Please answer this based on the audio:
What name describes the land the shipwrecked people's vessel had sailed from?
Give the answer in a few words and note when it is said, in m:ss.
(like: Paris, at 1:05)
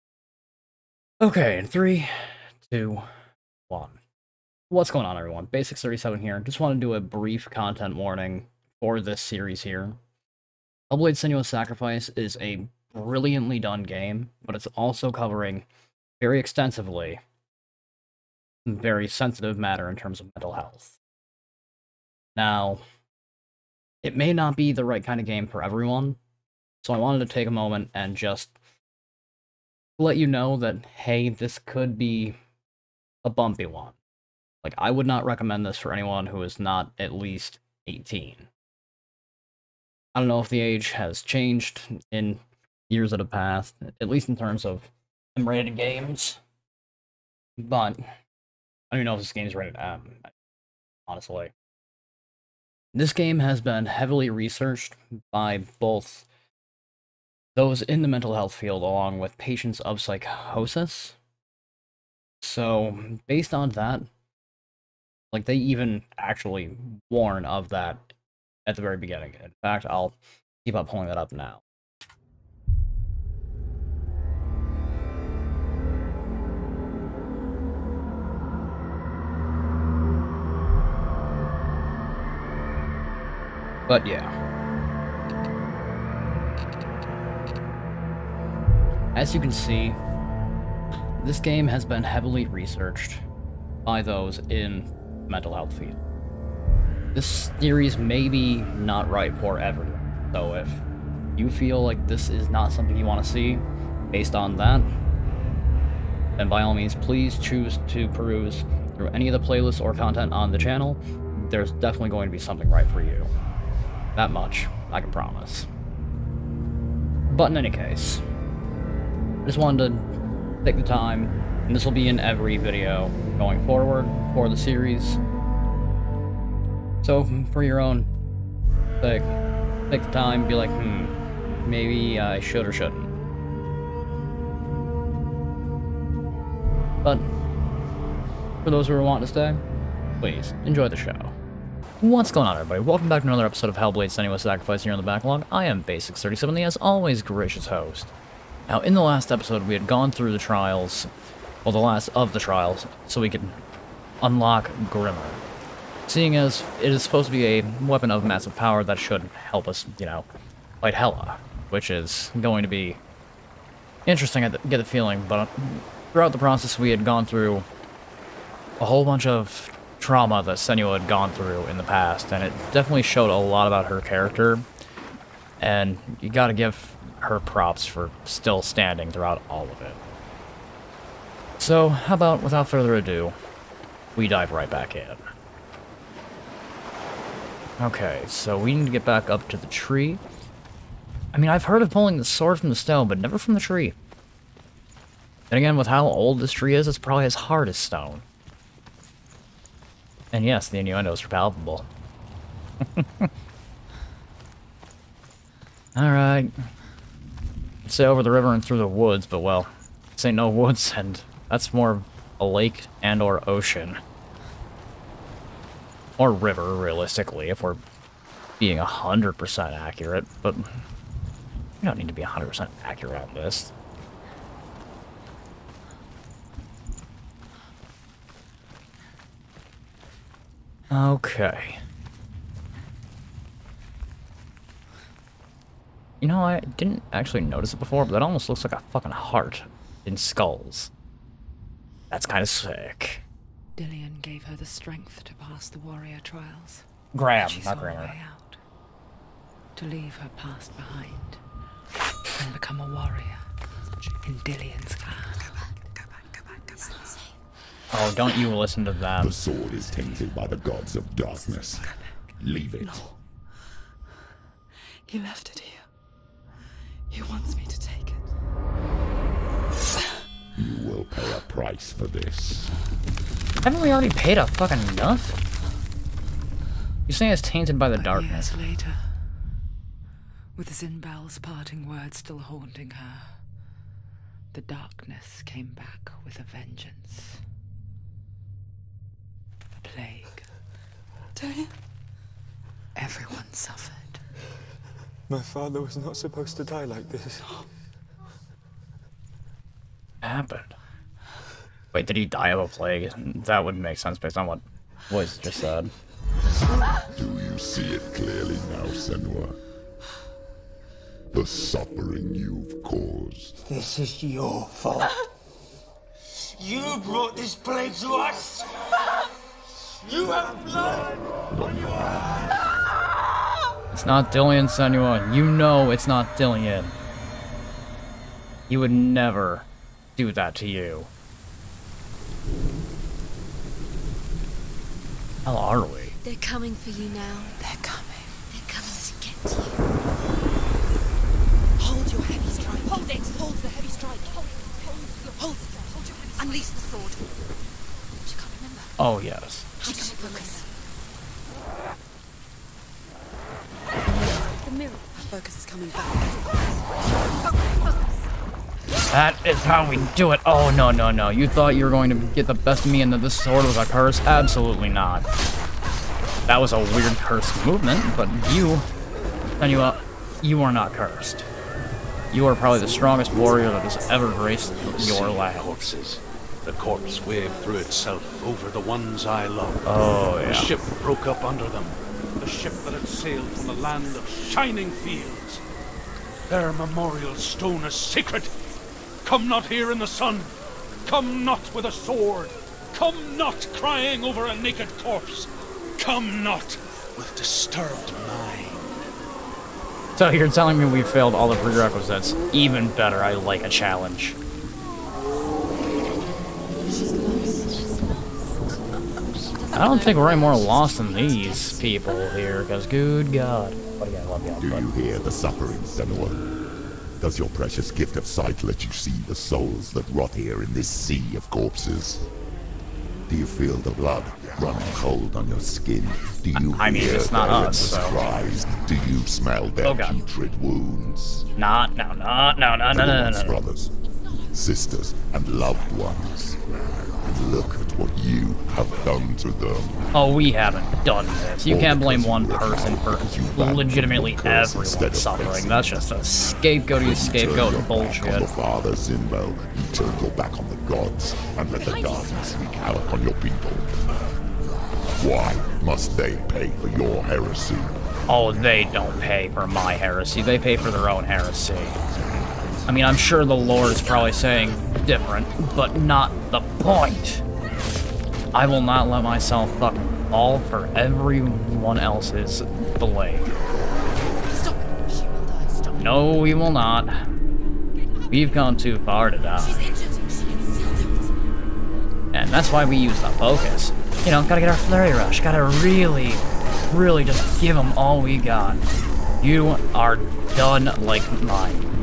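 land of shining fields, at 6:23.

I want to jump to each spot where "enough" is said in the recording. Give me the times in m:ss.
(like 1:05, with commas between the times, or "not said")
4:34.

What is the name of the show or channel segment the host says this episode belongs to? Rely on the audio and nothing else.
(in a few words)
the Backlog.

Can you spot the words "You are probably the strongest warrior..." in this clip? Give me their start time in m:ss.
6:12.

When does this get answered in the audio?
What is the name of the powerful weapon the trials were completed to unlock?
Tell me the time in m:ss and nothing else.
2:34.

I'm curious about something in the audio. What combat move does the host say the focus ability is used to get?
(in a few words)
flurry rush.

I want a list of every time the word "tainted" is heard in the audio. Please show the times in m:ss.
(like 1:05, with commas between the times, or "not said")
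4:19, 4:37.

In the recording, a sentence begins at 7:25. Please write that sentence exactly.
That's just a scapegoaty scapegoat bullshit.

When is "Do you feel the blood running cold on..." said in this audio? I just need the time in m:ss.
7:03.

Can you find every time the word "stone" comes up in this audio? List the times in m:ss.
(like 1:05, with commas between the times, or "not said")
3:12, 3:17, 6:27.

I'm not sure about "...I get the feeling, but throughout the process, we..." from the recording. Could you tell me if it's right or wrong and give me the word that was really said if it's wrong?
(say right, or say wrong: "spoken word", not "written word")
right.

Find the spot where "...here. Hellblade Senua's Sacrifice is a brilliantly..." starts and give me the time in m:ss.
0:09.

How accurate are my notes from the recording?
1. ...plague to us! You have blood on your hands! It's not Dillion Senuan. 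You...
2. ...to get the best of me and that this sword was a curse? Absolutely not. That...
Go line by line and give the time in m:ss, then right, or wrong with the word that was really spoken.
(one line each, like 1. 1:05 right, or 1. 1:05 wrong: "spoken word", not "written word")
1. 5:17 right
2. 6:02 right.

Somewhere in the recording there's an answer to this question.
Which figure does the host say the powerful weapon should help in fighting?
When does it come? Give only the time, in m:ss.
2:40.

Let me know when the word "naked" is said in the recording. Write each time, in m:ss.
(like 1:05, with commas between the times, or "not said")
6:34.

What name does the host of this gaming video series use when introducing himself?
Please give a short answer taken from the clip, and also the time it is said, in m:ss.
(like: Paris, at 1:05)
Basics37, at 0:05.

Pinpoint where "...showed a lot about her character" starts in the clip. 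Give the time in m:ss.
2:53.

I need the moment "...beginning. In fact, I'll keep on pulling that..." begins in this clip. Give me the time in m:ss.
1:08.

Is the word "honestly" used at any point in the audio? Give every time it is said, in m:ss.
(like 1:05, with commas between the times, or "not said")
0:51.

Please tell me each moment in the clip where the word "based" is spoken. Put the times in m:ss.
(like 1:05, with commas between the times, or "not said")
1:03, 1:44, 5:04.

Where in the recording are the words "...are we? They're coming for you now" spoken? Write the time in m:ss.
5:35.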